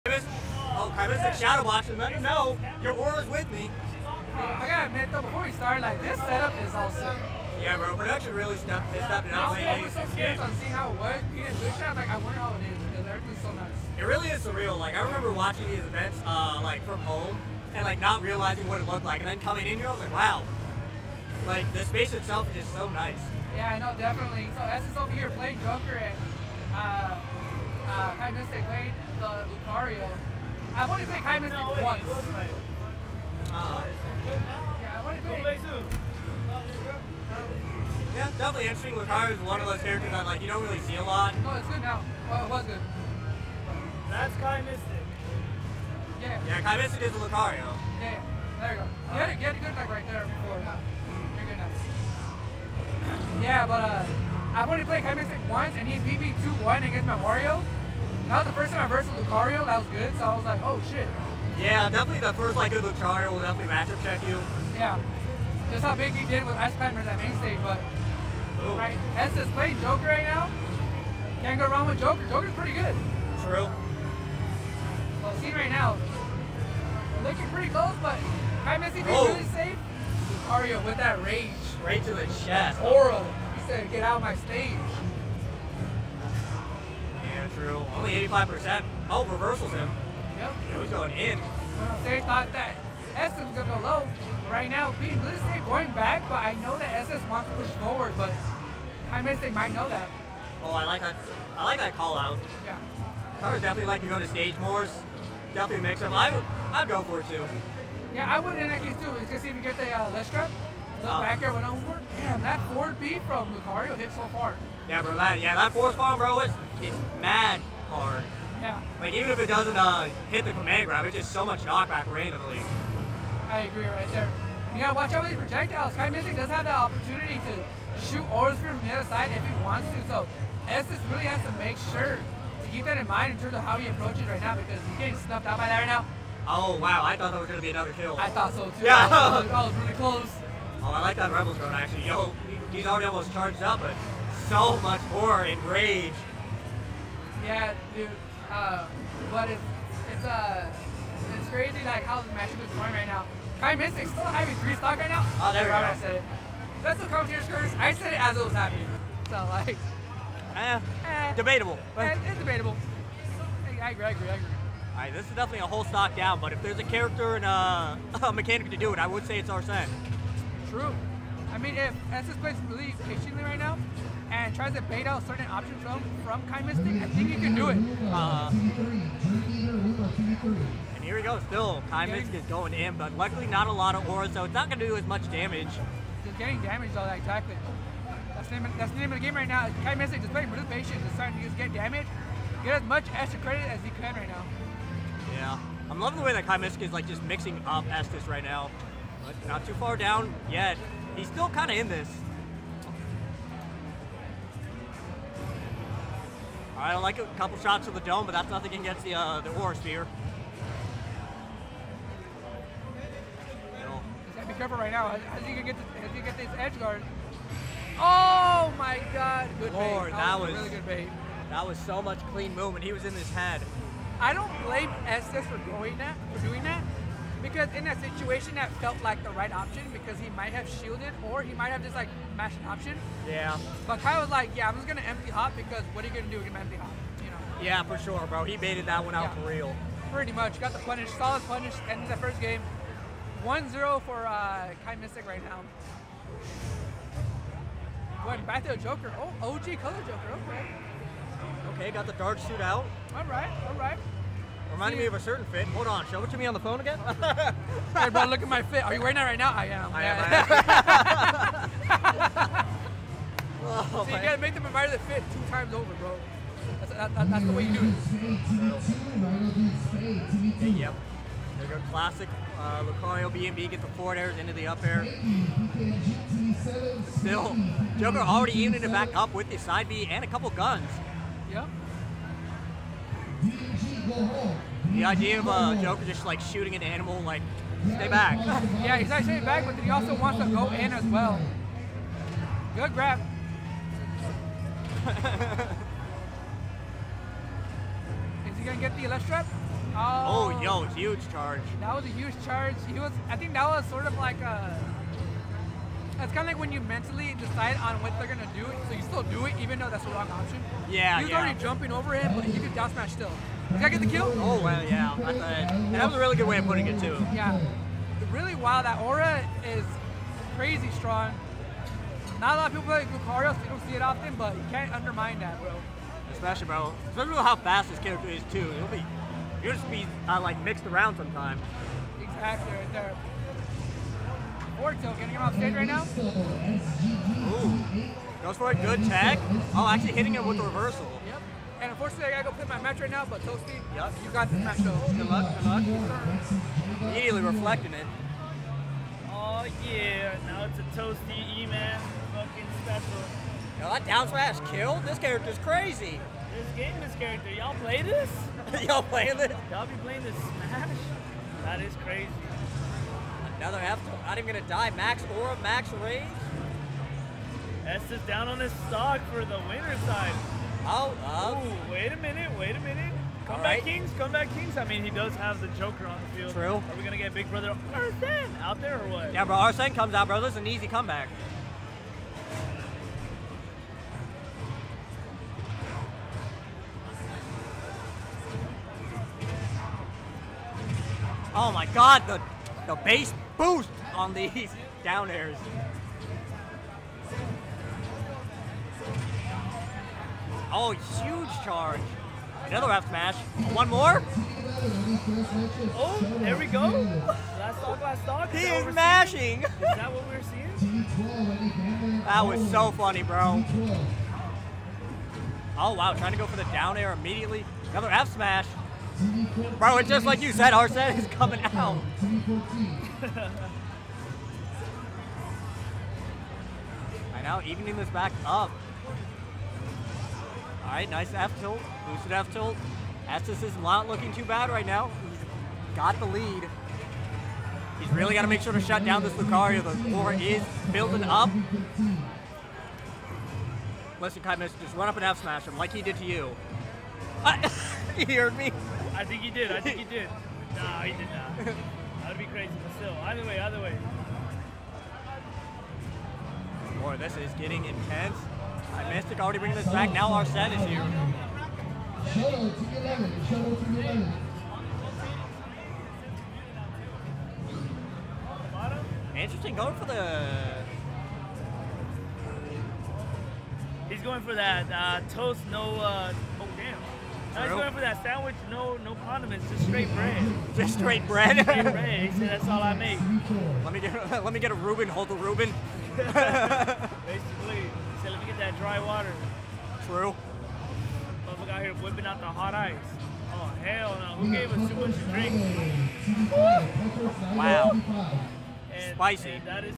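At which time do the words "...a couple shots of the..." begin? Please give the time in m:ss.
3:27.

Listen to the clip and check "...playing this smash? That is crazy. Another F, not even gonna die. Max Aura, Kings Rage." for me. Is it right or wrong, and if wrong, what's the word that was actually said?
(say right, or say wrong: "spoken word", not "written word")
wrong: "Max", not "Kings".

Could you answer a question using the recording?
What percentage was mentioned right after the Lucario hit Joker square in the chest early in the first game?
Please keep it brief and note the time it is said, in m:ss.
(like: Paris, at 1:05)
85%, at 1:28.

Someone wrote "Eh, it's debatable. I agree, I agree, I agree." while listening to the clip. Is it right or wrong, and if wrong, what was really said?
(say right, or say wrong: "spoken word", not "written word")
right.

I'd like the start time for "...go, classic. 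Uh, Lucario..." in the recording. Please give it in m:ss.
4:31.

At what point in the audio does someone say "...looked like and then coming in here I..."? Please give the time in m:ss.
0:18.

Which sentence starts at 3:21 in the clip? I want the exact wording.
He's still kind of in this.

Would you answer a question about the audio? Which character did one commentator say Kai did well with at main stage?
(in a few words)
Ice Climbers.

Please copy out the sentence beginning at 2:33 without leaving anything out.
Kai Mystic, still having three stock right now.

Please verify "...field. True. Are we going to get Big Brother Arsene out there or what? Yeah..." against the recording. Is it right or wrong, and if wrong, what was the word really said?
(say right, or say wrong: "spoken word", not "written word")
right.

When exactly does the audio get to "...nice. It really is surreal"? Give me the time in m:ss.
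0:13.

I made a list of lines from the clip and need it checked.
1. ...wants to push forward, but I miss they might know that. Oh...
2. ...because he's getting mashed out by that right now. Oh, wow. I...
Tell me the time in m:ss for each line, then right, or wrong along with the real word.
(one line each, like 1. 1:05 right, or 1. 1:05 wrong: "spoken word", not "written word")
1. 1:37 right
2. 2:14 wrong: "snuffed", not "mashed".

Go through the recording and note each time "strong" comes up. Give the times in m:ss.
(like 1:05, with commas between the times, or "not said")
5:20.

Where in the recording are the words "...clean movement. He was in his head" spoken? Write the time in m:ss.
3:42.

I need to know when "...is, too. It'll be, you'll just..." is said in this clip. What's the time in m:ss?
5:28.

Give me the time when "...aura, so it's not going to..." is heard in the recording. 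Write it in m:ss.
3:04.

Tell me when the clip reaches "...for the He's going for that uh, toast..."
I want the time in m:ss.
7:49.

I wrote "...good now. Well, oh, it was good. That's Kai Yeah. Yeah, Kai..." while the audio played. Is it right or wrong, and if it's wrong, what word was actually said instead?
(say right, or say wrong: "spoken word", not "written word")
right.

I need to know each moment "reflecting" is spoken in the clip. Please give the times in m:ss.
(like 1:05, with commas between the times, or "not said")
5:47.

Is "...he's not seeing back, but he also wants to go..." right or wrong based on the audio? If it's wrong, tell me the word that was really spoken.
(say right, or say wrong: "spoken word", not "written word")
wrong: "staying", not "seeing".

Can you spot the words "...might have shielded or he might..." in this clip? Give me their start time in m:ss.
3:50.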